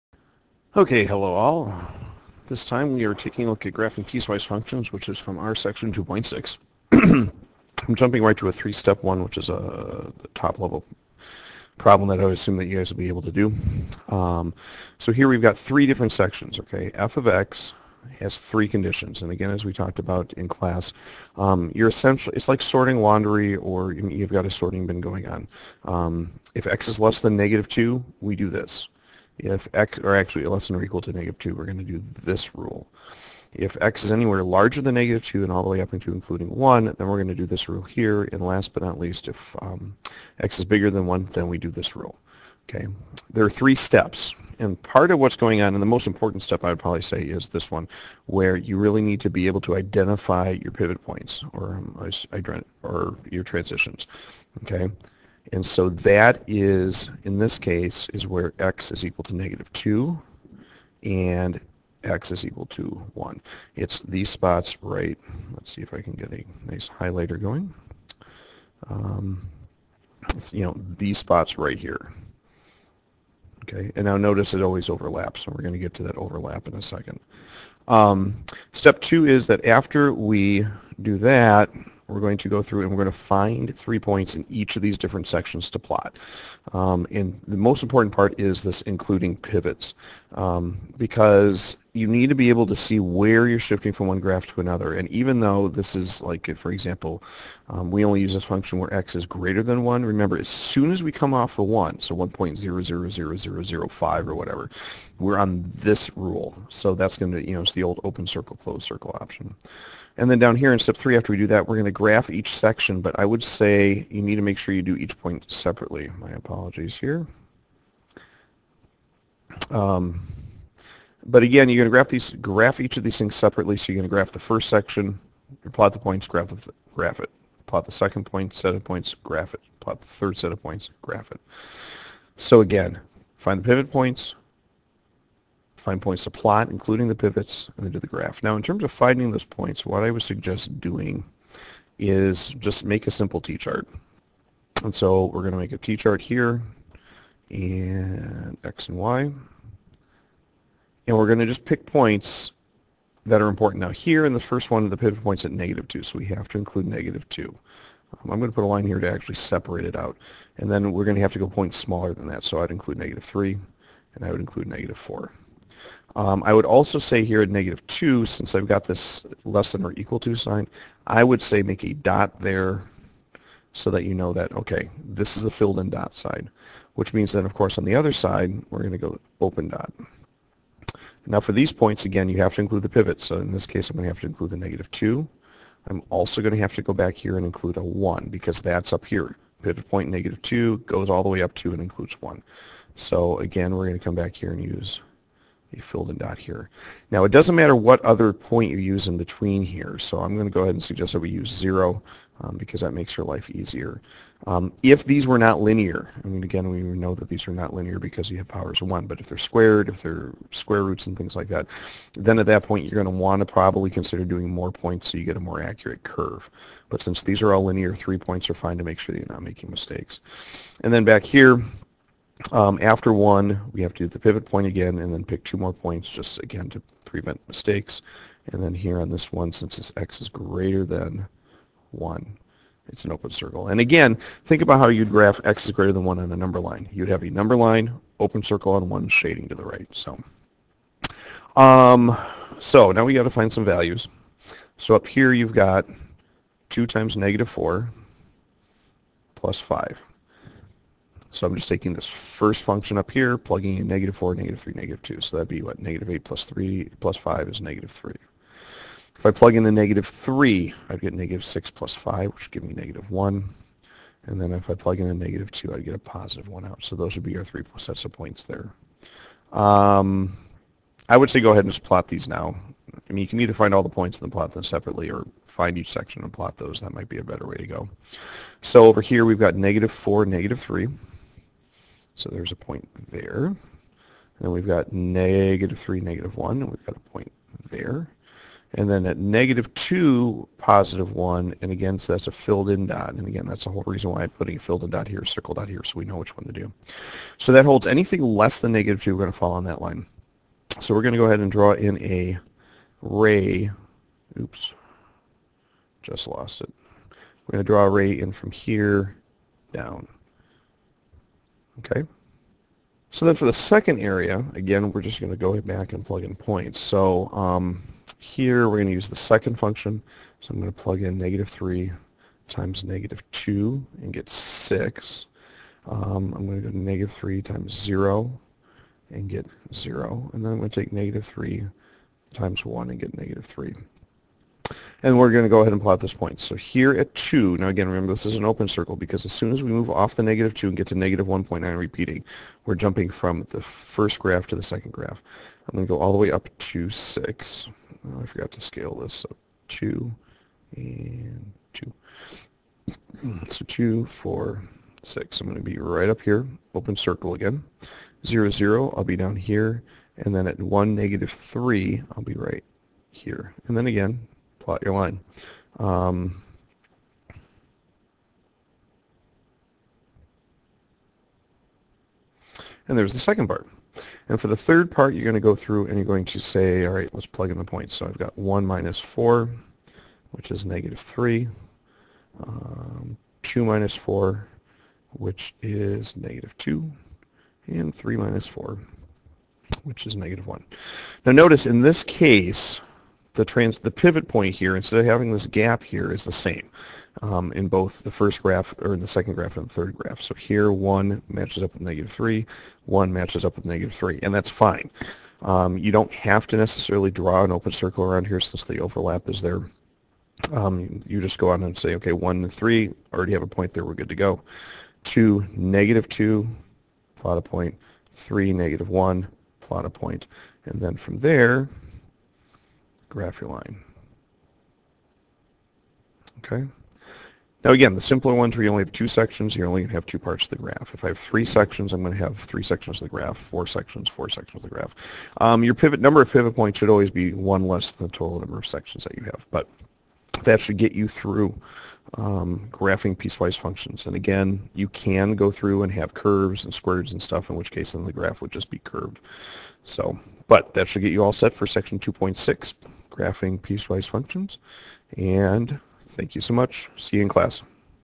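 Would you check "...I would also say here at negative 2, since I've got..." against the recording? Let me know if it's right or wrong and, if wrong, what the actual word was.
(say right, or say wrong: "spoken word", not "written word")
right.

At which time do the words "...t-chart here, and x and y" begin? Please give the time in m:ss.
2:25.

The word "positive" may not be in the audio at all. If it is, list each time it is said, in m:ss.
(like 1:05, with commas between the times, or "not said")
4:25, 4:50.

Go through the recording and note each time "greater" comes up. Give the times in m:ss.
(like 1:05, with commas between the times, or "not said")
1:39, 3:50, 3:55.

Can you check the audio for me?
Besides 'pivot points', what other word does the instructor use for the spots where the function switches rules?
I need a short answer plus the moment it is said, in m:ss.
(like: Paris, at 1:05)
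Transitions, at 0:53.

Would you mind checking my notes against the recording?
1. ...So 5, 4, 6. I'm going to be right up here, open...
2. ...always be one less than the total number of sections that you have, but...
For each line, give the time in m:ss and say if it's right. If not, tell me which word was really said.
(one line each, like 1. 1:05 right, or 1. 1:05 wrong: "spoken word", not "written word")
1. 5:53 wrong: "2", not "5"
2. 7:16 right.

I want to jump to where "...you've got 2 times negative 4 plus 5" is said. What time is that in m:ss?
4:05.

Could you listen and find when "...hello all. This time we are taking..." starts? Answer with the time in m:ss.
0:01.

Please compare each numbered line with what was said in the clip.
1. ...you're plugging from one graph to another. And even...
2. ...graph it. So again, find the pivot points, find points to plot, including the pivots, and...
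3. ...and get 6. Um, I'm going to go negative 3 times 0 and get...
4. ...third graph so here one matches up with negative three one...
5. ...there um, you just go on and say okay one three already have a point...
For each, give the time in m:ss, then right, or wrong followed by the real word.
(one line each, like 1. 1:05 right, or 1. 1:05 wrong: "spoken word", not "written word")
1. 1:33 wrong: "shifting", not "plugging"
2. 2:11 right
3. 5:24 right
4. 6:39 right
5. 6:49 right.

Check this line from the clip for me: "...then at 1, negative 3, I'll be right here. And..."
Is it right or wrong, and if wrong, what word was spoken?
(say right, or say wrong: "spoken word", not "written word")
right.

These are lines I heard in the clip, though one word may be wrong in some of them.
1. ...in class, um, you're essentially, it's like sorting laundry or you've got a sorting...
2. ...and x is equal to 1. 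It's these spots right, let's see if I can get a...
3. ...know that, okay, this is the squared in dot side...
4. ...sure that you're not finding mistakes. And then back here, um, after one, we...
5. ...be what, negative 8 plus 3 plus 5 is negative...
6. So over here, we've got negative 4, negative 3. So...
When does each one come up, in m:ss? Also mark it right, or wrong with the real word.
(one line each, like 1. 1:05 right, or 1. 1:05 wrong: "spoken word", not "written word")
1. 0:20 right
2. 1:01 right
3. 2:54 wrong: "filled", not "squared"
4. 3:38 wrong: "making", not "finding"
5. 4:15 right
6. 4:38 right.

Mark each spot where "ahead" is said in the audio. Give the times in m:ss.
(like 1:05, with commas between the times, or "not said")
3:20, 4:31, 5:01, 5:35.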